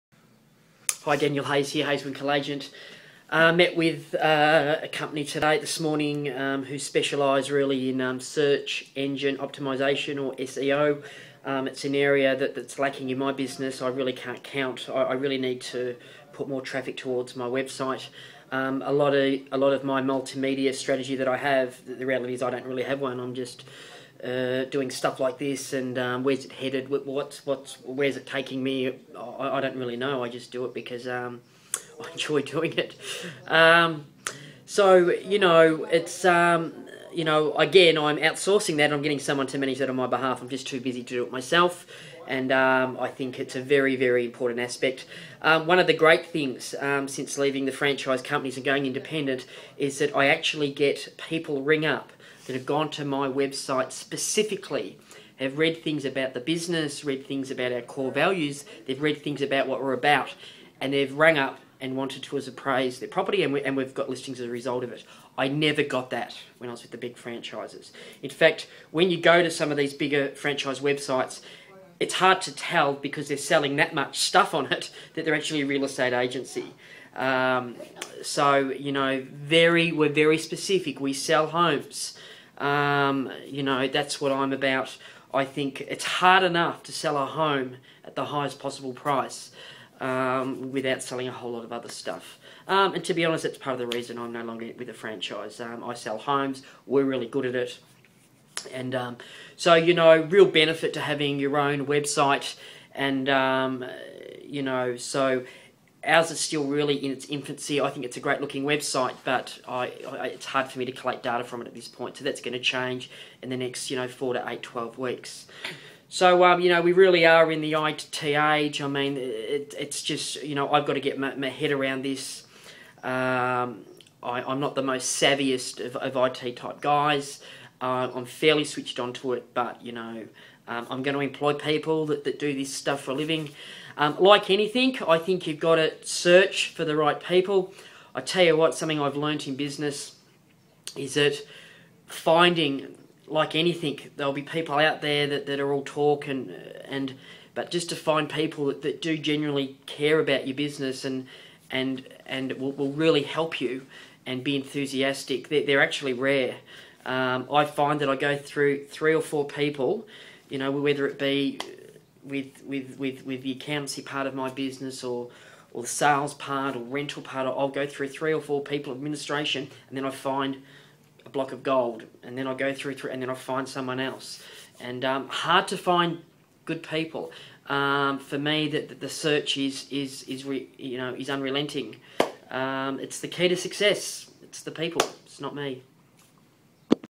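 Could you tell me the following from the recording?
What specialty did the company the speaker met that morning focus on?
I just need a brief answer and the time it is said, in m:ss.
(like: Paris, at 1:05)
search engine optimisation, at 0:08.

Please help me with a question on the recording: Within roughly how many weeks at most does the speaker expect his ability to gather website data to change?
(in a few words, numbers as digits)
12.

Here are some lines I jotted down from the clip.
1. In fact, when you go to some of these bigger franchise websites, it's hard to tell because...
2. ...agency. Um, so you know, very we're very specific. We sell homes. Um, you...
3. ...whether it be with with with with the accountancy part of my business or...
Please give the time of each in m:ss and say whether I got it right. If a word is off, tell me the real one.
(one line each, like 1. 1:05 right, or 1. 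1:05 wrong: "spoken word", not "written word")
1. 1:08 right
2. 1:16 right
3. 2:40 right.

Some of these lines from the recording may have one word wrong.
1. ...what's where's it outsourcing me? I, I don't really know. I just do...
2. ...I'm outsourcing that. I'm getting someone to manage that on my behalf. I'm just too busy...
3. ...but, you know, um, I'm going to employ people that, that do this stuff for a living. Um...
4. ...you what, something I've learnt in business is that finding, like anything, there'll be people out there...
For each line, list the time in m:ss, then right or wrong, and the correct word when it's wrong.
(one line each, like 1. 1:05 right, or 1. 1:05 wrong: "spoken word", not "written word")
1. 0:27 wrong: "taking", not "outsourcing"
2. 0:37 right
3. 2:09 right
4. 2:18 right.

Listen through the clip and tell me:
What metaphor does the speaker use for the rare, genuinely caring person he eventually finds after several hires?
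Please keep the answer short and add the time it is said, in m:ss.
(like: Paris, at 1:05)
a block of gold, at 2:51.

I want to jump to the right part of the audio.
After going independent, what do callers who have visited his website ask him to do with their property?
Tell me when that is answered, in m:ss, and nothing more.
1:02.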